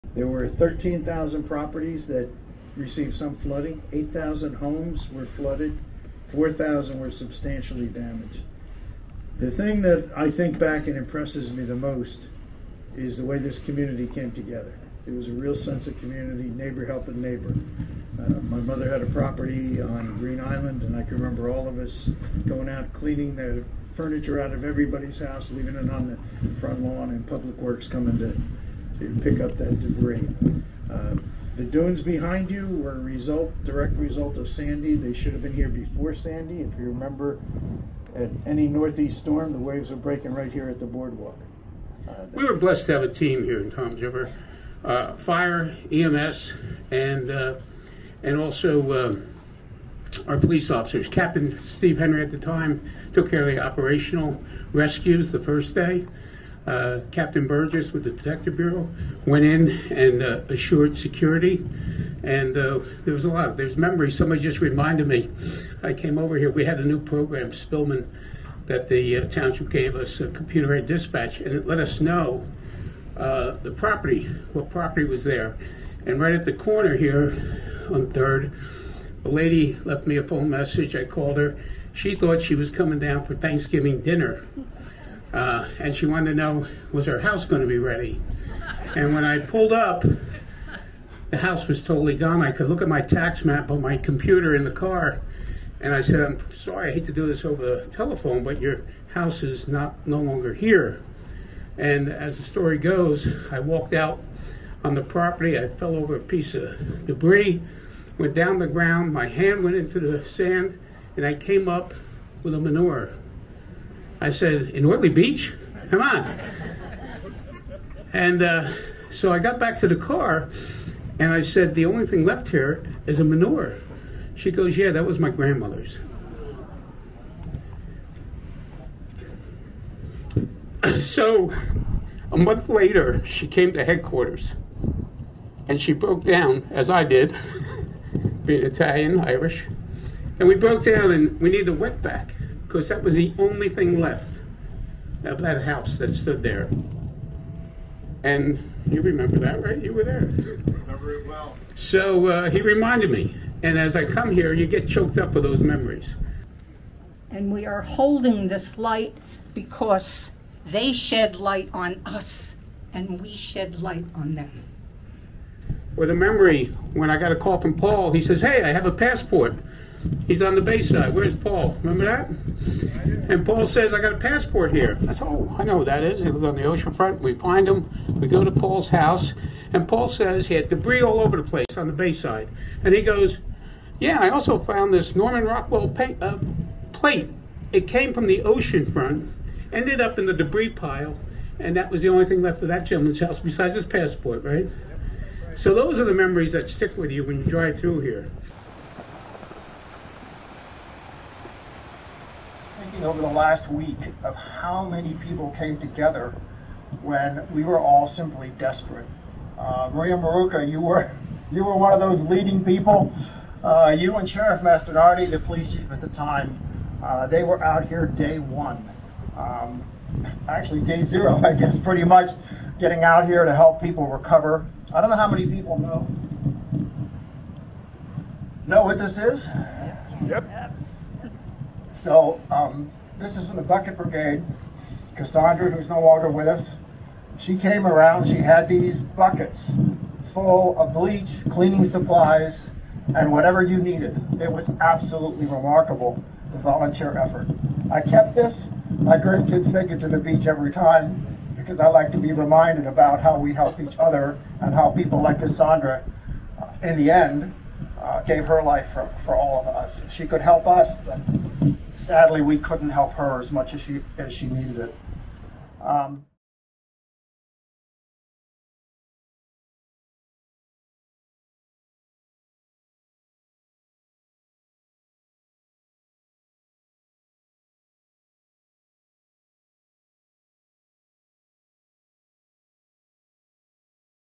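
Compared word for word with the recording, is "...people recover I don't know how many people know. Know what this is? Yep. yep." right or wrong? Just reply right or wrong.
right.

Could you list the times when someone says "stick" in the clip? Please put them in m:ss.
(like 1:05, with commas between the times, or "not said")
3:16.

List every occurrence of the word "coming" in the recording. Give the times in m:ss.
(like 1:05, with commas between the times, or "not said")
0:27, 1:22.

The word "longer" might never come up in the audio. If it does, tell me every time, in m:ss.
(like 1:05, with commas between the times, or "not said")
1:40, 3:56.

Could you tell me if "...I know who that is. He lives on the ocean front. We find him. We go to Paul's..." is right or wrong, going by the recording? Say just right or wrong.
right.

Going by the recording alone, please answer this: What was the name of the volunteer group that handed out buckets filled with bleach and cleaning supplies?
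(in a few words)
Bucket Brigade.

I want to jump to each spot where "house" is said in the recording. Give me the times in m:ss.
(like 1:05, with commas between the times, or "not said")
0:25, 1:27, 1:31, 1:39, 2:25, 2:58, 3:13.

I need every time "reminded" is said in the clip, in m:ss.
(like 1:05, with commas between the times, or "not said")
1:04, 2:32, 4:12.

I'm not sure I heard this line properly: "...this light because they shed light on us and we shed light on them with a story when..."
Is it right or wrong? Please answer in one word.
wrong.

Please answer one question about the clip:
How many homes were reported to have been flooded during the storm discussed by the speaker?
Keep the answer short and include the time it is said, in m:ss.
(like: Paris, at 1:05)
8,000, at 0:03.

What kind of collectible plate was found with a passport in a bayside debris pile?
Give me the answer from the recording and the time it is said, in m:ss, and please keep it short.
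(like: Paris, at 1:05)
Norman Rockwell, at 3:05.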